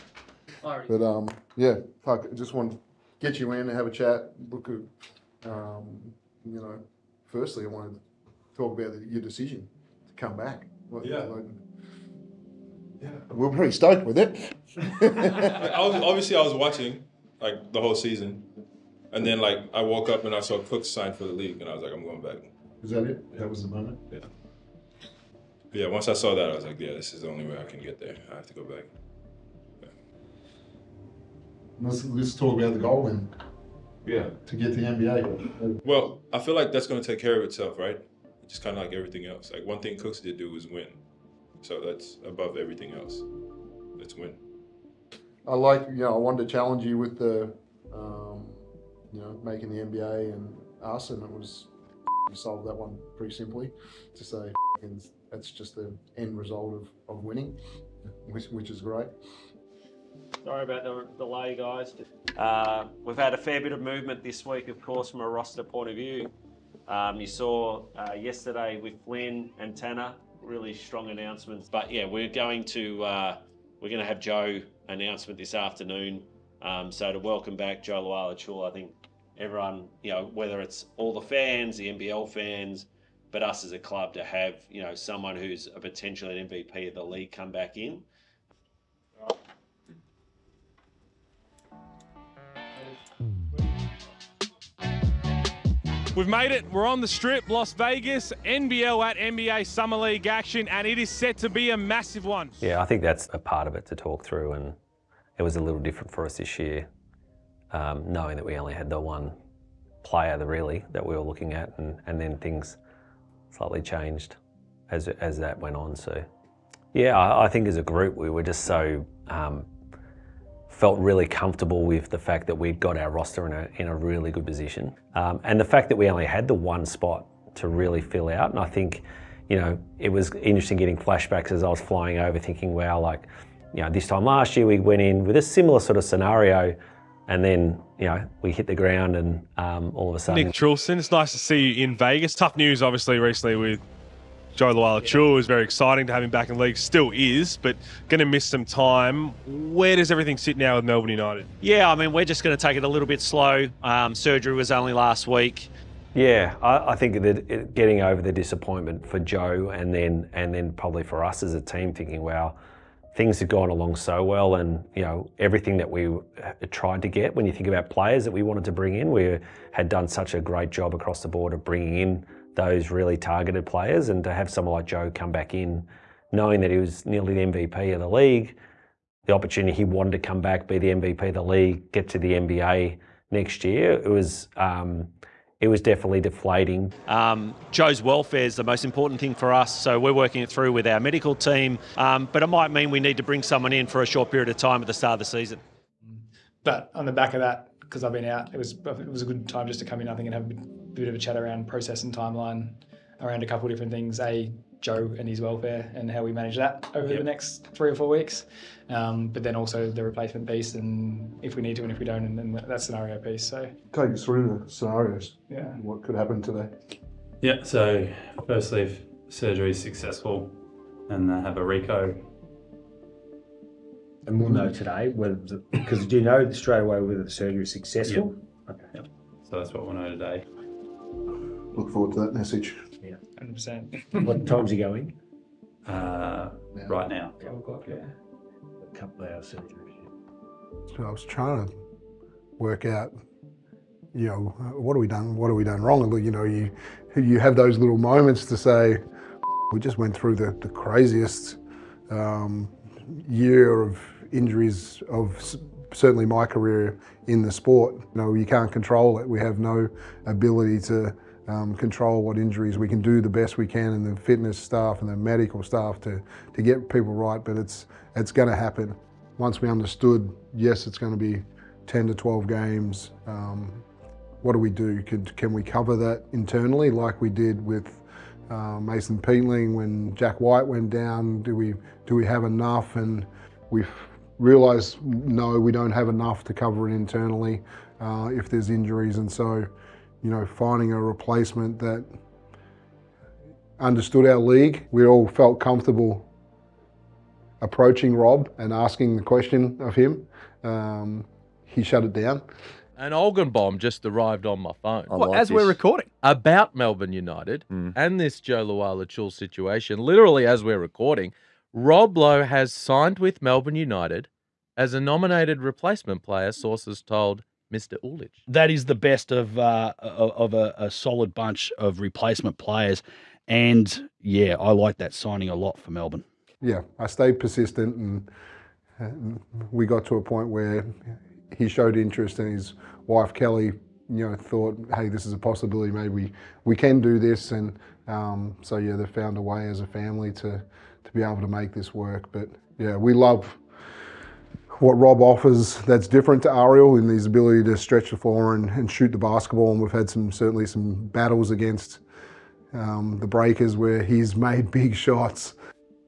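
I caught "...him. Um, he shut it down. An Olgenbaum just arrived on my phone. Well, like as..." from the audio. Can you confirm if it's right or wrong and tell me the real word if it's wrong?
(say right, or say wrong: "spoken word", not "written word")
right.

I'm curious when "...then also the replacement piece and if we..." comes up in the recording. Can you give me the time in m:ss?
3:29.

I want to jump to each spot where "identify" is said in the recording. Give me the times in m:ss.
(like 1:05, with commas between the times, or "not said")
not said.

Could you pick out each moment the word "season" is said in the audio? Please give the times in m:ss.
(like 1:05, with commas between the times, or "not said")
0:17, 3:15.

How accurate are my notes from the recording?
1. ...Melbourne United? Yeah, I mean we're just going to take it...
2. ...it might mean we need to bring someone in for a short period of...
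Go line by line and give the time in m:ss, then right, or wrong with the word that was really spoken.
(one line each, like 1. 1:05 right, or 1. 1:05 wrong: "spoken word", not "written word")
1. 2:30 right
2. 3:12 right.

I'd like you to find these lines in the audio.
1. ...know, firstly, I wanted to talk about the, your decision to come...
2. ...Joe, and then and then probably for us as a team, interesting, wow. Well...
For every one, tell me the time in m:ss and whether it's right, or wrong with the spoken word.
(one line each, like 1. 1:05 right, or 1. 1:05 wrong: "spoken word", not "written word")
1. 0:06 right
2. 2:39 wrong: "thinking", not "interesting".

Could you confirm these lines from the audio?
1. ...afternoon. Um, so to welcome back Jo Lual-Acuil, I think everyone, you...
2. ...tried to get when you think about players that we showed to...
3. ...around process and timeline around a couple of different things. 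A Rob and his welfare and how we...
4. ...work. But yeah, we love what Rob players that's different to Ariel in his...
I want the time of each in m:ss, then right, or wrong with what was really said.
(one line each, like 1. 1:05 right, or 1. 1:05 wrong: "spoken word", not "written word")
1. 1:15 right
2. 2:46 wrong: "wanted", not "showed"
3. 3:21 wrong: "Joe", not "Rob"
4. 5:41 wrong: "offers", not "players".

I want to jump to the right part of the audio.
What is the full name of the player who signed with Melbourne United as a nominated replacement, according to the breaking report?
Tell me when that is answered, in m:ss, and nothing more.
5:11.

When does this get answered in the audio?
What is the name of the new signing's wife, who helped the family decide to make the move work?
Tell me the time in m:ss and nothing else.
5:33.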